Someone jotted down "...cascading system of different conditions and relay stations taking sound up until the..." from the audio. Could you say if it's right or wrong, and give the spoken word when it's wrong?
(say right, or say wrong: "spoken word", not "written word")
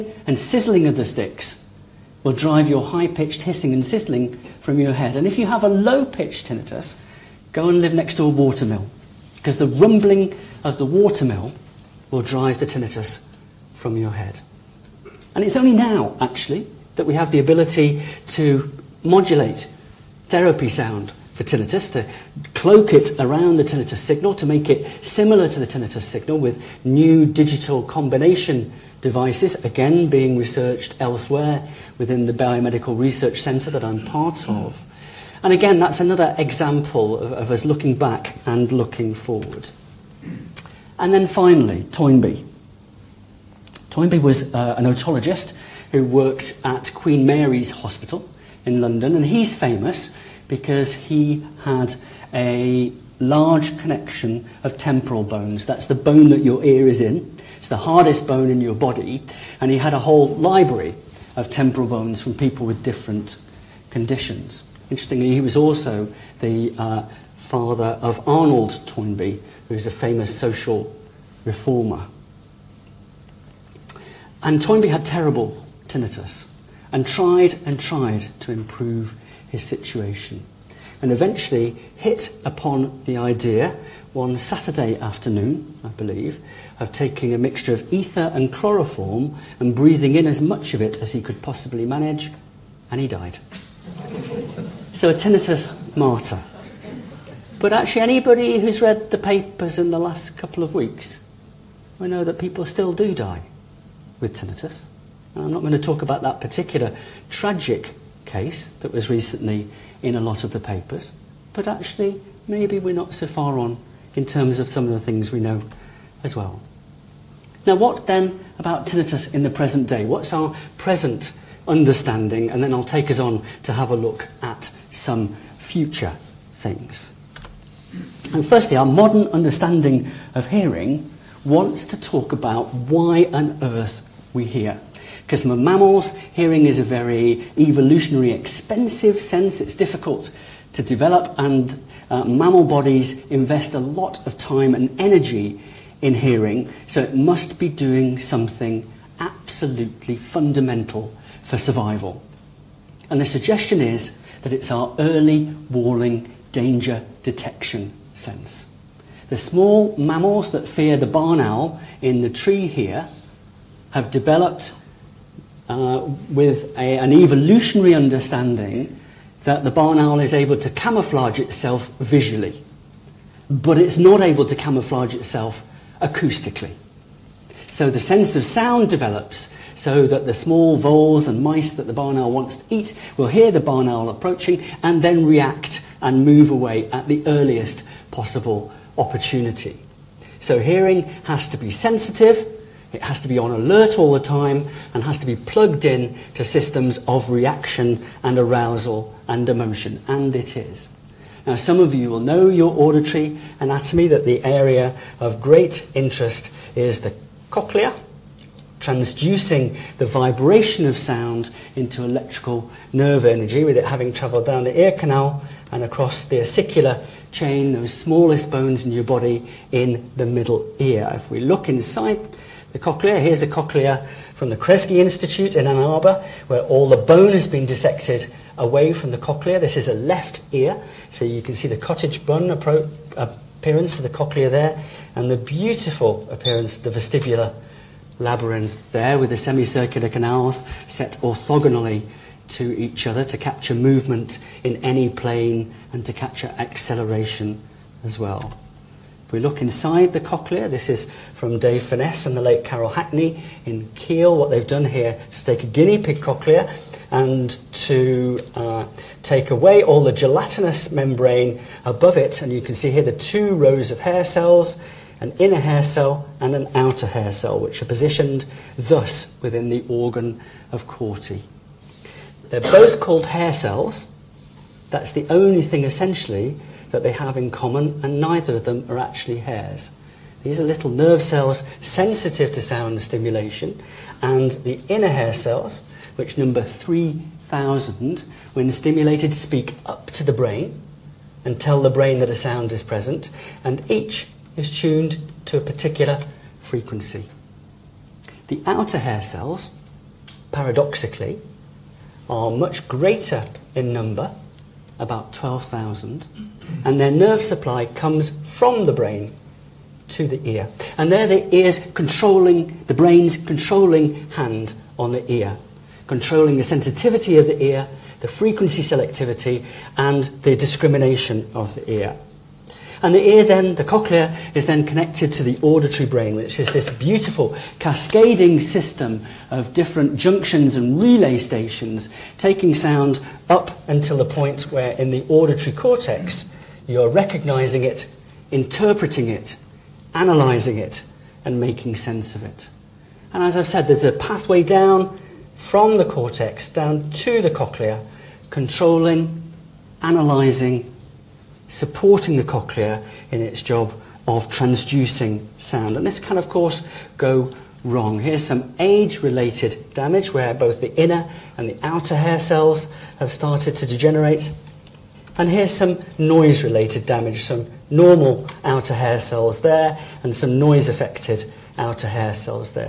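wrong: "junctions", not "conditions".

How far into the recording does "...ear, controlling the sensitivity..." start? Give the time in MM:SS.
05:15.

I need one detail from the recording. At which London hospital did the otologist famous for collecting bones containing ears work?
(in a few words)
Queen Mary's Hospital.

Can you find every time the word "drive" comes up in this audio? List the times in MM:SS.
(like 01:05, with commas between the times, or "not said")
00:02, 00:12.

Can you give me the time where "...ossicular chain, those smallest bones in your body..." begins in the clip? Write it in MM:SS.
03:36.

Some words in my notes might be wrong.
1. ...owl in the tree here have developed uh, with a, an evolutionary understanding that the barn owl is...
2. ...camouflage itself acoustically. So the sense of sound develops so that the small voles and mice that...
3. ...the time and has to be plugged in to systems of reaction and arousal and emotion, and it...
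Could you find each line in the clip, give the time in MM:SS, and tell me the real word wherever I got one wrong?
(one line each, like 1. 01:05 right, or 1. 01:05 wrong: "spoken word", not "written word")
1. 02:41 right
2. 02:54 right
3. 03:14 right.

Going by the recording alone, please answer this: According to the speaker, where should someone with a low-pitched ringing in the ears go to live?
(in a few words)
Next to a watermill.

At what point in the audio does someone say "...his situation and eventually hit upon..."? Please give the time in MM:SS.
01:19.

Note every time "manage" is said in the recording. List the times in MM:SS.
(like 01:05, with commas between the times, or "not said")
01:31.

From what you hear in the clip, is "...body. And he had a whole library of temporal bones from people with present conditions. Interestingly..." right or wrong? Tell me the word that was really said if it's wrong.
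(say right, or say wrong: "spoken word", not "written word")
wrong: "different", not "present".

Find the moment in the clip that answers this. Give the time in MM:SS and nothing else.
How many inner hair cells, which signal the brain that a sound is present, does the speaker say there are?
04:46.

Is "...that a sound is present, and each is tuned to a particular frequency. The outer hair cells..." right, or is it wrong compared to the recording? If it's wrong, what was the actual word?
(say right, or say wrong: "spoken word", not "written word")
right.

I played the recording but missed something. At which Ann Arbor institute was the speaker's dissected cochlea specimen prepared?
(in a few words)
Kresge Institute.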